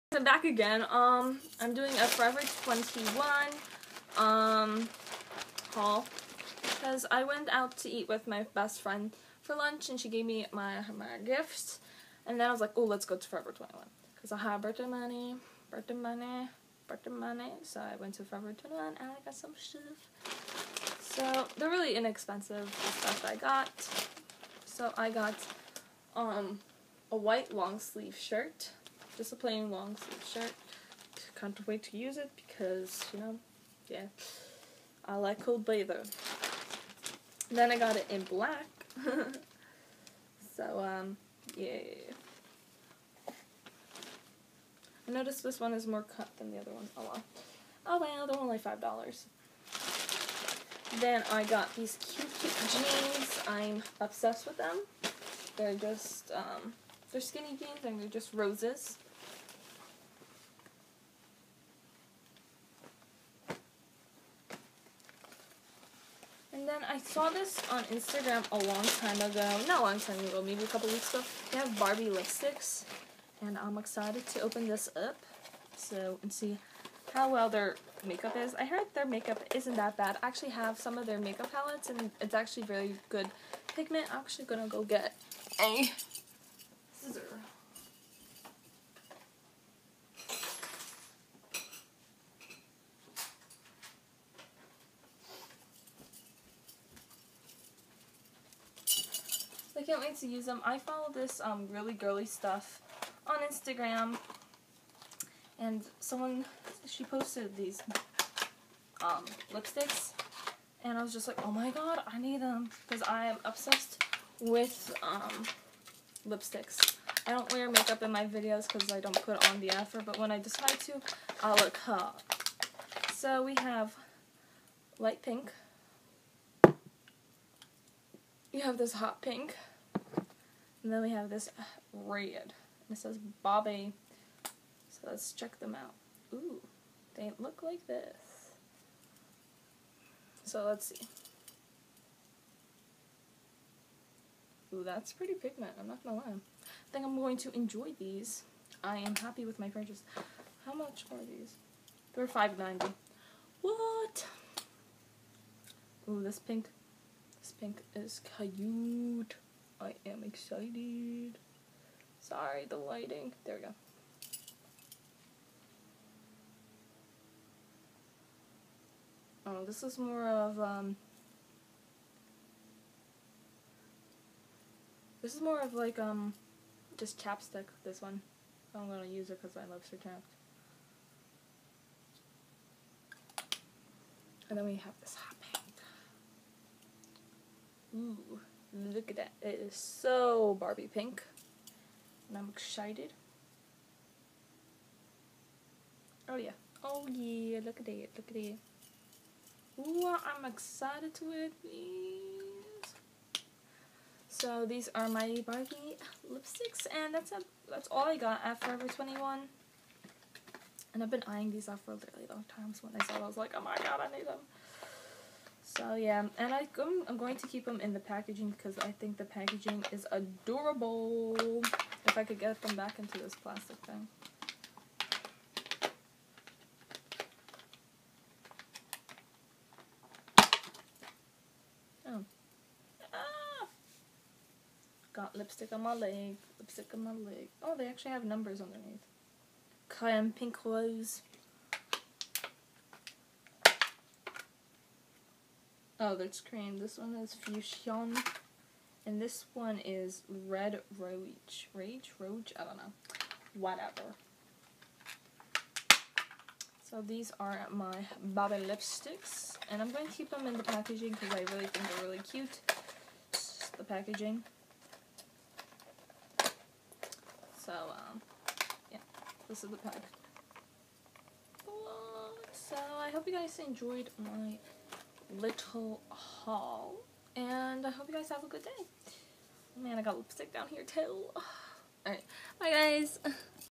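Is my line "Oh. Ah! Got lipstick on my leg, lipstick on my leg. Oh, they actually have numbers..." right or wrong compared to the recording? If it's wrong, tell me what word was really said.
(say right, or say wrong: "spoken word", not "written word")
right.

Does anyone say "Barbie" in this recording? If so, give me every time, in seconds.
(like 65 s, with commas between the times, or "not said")
71 s, 133 s, 190 s, 205 s, 258 s.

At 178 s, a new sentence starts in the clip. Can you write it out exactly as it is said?
I'm gonna use it because I love Sir Chapped.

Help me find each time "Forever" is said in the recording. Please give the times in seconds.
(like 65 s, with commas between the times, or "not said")
2 s, 13 s, 18 s, 208 s.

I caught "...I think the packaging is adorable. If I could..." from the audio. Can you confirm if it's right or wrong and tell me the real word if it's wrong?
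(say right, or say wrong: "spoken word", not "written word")
right.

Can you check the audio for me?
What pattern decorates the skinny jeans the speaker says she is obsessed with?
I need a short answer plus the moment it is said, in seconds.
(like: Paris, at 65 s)
Roses, at 58 s.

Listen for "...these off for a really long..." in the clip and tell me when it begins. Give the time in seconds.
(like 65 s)
211 s.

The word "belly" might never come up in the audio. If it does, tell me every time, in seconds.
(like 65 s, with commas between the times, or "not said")
not said.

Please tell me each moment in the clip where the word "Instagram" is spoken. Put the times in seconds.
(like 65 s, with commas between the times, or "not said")
67 s, 103 s.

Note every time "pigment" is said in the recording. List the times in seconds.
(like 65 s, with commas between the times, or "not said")
83 s, 145 s.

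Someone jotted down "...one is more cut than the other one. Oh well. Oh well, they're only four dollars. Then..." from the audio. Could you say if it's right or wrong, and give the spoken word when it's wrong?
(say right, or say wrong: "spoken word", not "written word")
wrong: "five", not "four".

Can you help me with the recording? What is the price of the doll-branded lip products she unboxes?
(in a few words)
$5.90.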